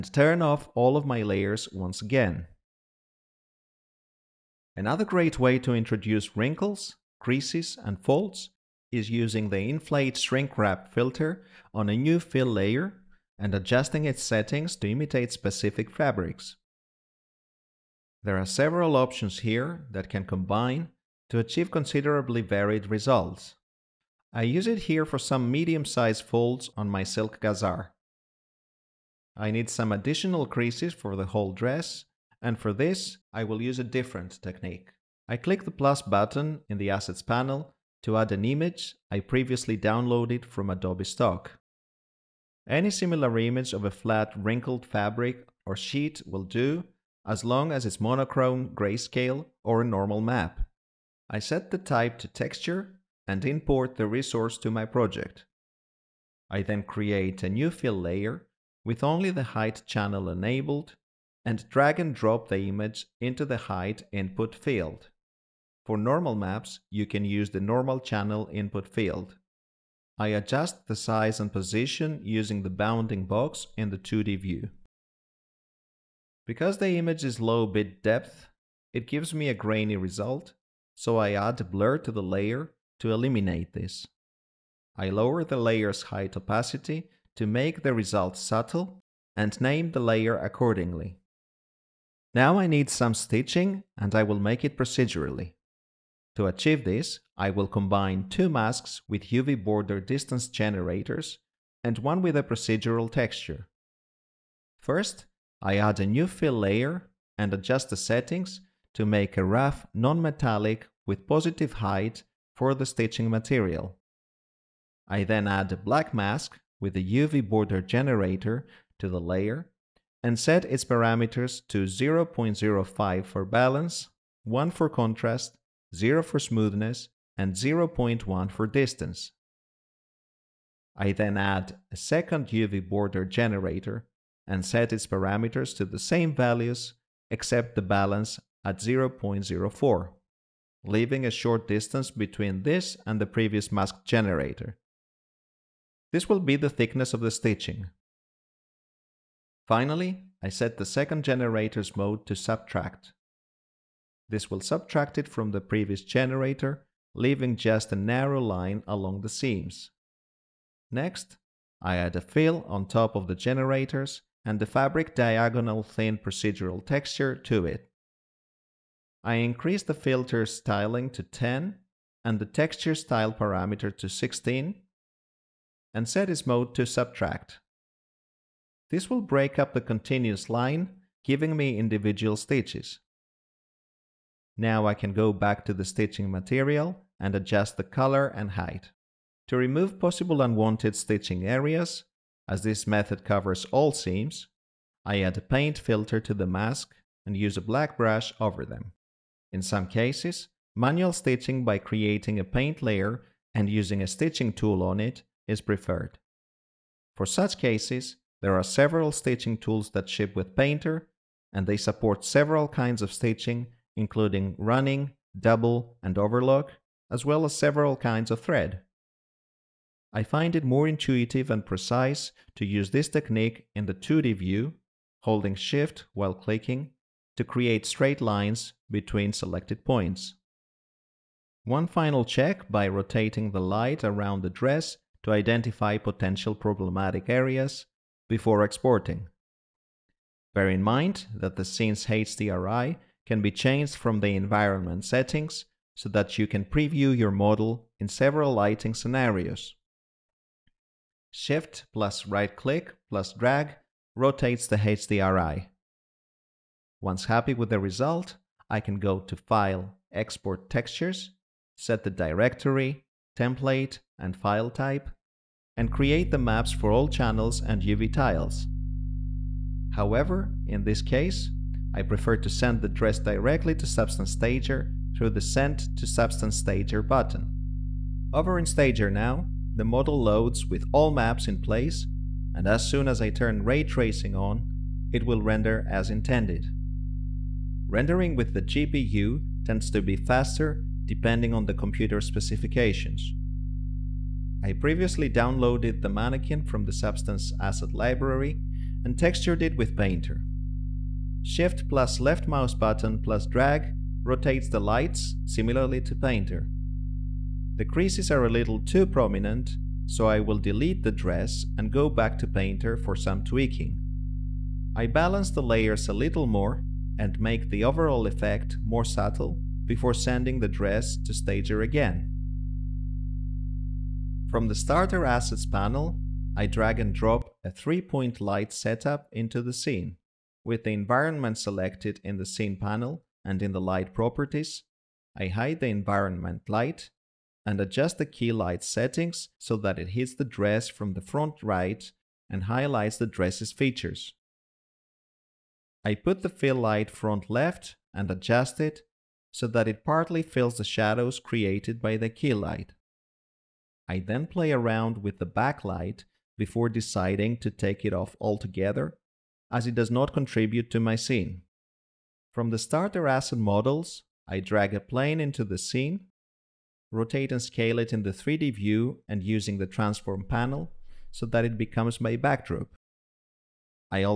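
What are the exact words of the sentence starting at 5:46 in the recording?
I put the fill light front left and adjust it so that it partly fills the shadows created by the key light.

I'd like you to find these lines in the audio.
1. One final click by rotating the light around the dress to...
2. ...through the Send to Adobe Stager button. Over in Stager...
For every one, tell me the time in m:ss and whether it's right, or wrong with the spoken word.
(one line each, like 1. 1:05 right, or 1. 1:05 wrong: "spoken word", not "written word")
1. 3:51 wrong: "check", not "click"
2. 4:35 wrong: "Substance", not "Adobe".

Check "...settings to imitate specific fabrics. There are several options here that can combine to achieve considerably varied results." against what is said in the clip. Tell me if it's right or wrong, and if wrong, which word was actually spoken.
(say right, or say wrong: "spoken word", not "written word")
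right.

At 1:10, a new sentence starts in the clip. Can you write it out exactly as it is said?
I adjust the size and position using the bounding box in the 2D view.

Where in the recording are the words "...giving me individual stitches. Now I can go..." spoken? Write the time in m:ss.
3:01.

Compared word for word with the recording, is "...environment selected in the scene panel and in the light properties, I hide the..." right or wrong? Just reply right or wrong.
right.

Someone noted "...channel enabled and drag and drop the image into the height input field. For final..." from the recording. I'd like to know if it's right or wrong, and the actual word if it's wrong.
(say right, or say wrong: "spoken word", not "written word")
wrong: "normal", not "final".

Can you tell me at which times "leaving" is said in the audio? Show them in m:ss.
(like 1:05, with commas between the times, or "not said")
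2:20, 2:37.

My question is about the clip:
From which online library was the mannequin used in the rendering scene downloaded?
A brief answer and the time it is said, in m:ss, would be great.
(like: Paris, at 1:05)
Substance Asset Library, at 4:56.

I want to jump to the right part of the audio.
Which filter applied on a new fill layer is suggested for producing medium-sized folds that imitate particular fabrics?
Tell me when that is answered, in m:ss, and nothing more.
0:09.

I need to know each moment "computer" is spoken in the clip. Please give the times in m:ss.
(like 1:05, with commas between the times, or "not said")
4:51.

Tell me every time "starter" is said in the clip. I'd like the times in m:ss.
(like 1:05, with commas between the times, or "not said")
5:24, 6:02.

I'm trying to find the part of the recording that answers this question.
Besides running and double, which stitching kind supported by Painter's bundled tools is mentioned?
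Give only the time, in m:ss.
3:36.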